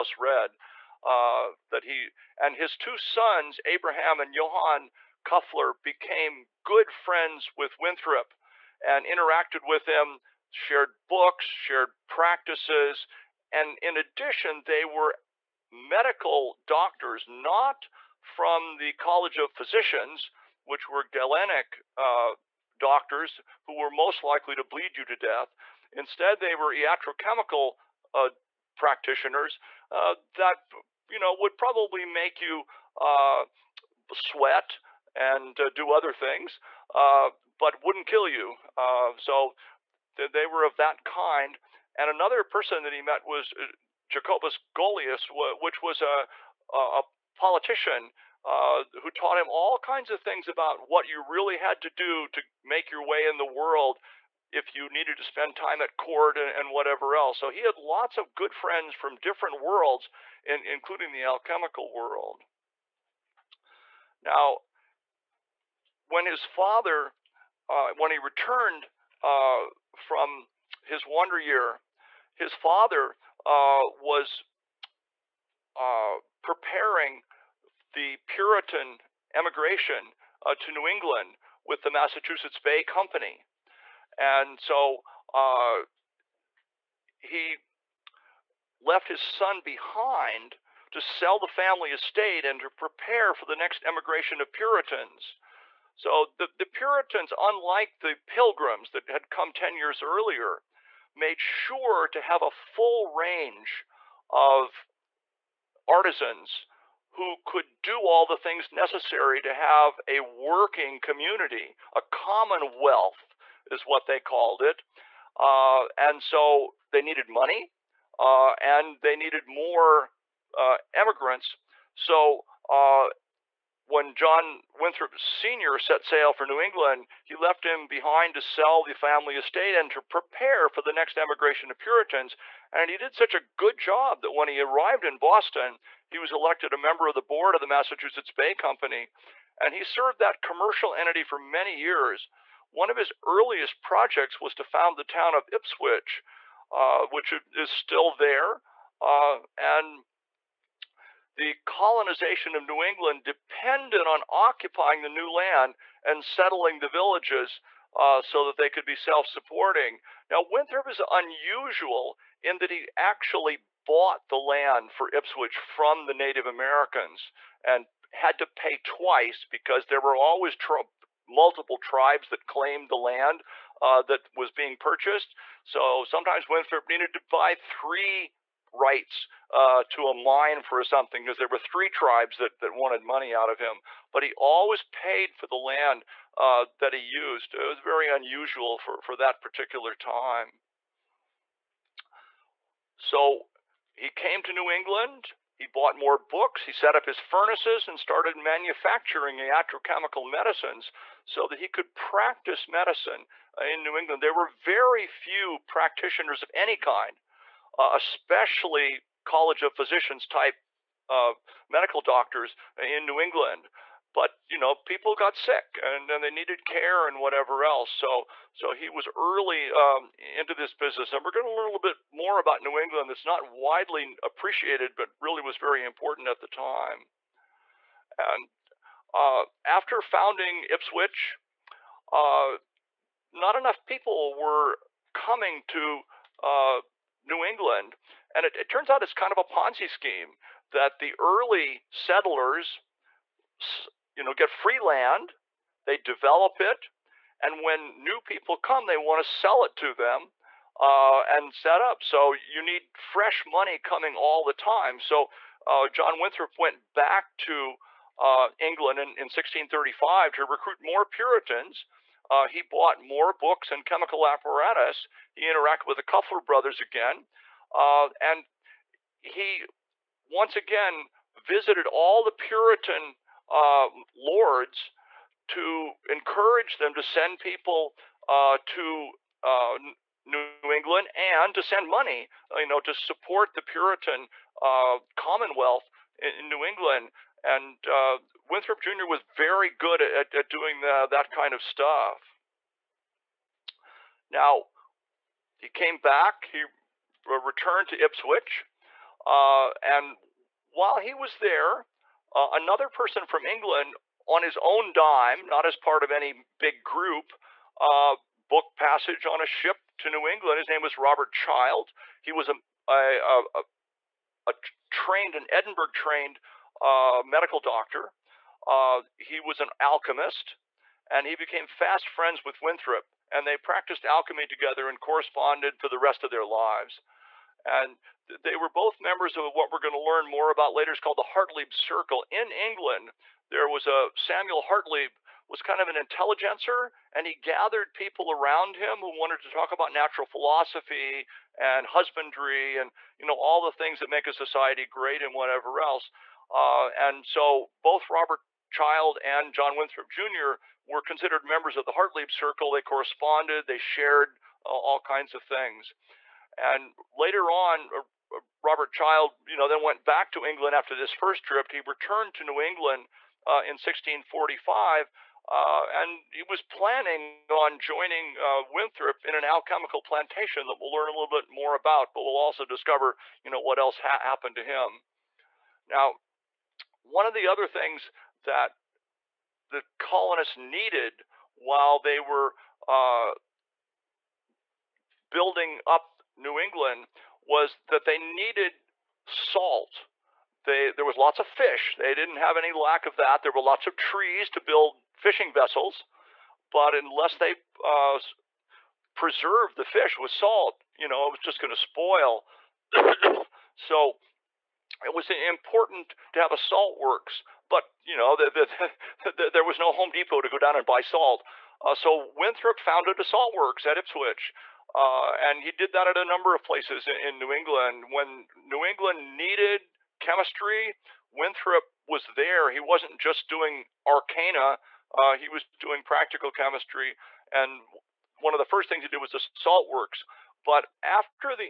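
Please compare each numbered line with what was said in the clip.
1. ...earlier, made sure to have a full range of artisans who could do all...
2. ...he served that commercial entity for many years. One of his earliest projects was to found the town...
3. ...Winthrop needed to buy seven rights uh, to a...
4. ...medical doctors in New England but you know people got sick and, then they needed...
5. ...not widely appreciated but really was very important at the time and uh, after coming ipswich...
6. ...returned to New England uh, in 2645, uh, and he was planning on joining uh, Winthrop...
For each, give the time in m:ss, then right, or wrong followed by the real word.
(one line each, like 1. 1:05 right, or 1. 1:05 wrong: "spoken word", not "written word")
1. 1:40 right
2. 2:19 right
3. 2:56 wrong: "three", not "seven"
4. 3:31 right
5. 3:43 wrong: "founding", not "coming"
6. 6:01 wrong: "1645", not "2645".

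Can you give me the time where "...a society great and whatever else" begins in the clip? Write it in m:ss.
5:44.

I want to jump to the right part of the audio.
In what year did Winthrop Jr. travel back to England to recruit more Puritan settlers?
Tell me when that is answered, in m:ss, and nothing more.
4:19.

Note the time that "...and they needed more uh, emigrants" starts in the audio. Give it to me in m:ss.
1:58.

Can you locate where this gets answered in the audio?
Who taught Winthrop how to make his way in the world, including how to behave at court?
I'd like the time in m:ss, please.
0:44.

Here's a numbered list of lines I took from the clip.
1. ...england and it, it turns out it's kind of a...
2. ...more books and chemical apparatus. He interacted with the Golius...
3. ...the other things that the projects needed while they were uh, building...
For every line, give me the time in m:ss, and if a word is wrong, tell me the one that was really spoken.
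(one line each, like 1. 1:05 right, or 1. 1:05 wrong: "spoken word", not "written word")
1. 3:57 right
2. 4:23 wrong: "Kuffler", not "Golius"
3. 6:17 wrong: "colonists", not "projects".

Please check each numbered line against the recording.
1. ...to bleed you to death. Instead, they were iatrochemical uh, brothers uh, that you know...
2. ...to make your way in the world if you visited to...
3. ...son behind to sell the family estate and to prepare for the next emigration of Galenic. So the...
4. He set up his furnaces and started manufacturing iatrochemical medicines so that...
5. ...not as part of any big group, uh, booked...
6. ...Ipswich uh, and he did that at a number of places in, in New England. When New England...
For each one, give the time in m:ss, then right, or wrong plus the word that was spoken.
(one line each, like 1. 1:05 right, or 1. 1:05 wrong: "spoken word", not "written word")
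1. 0:24 wrong: "practitioners", not "brothers"
2. 0:52 wrong: "needed", not "visited"
3. 1:29 wrong: "Puritans", not "Galenic"
4. 3:16 right
5. 5:05 right
6. 6:53 right.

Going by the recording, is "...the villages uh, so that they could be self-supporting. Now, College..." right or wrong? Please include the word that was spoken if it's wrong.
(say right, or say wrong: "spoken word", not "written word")
wrong: "Winthrop", not "College".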